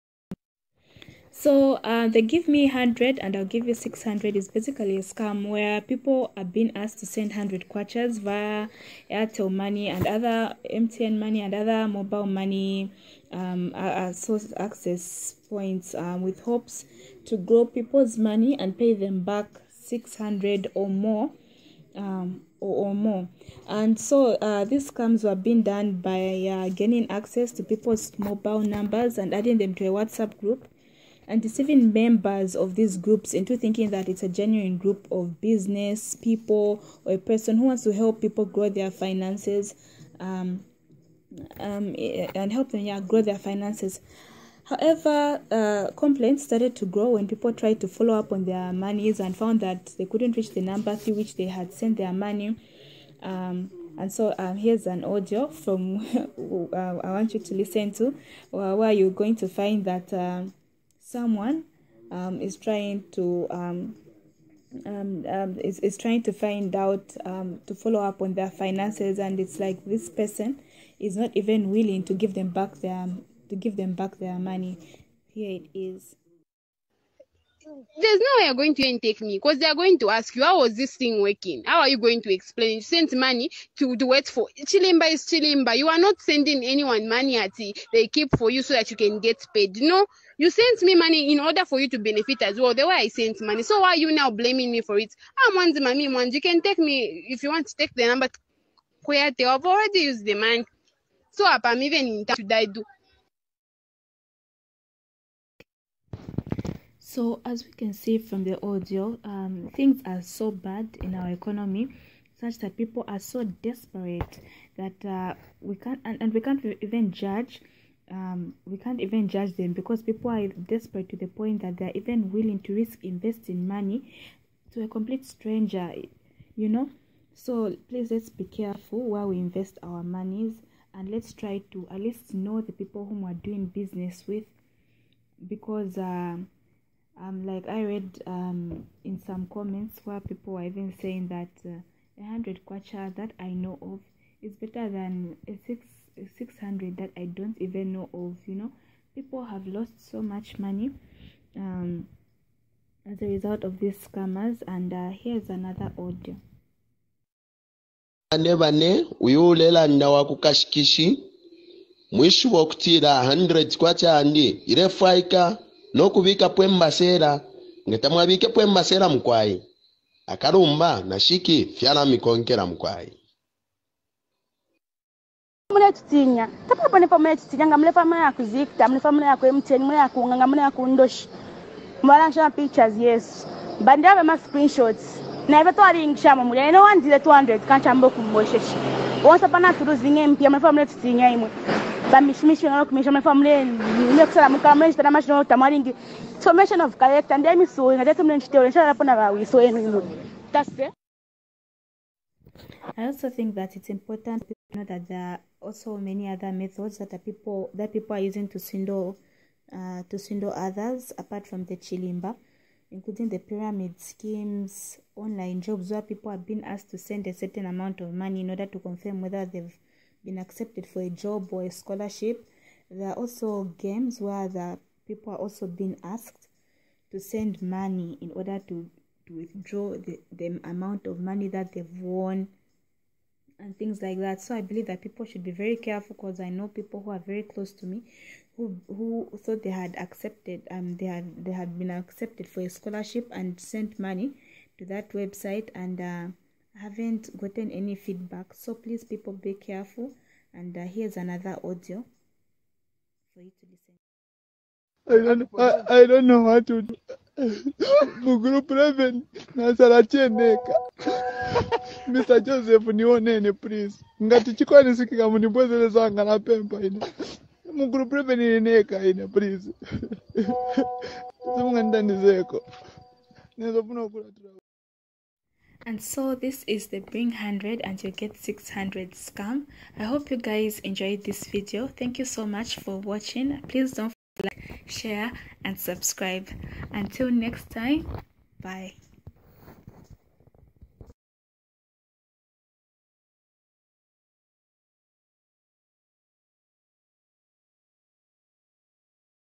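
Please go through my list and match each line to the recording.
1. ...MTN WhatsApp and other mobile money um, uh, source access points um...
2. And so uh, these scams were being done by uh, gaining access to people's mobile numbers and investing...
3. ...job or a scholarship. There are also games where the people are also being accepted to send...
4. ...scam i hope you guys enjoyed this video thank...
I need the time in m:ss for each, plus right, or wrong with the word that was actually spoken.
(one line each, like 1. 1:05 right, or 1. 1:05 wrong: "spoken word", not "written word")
1. 0:10 wrong: "Money", not "WhatsApp"
2. 0:23 wrong: "adding", not "investing"
3. 3:41 wrong: "asked", not "accepted"
4. 4:39 right.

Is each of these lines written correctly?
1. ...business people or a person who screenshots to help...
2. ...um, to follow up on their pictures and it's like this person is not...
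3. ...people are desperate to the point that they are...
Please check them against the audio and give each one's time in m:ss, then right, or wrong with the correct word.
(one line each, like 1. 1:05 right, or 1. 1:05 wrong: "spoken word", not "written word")
1. 0:35 wrong: "wants", not "screenshots"
2. 1:07 wrong: "finances", not "pictures"
3. 2:00 right.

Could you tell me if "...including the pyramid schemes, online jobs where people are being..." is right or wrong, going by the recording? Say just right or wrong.
right.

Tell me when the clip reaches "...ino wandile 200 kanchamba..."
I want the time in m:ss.
3:06.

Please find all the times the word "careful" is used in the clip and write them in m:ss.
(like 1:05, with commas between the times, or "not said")
2:08, 3:55, 4:09.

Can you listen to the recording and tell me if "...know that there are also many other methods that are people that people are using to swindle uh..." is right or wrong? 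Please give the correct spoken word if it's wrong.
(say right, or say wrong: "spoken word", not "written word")
right.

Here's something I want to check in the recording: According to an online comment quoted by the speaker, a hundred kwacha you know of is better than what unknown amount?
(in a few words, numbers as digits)
600.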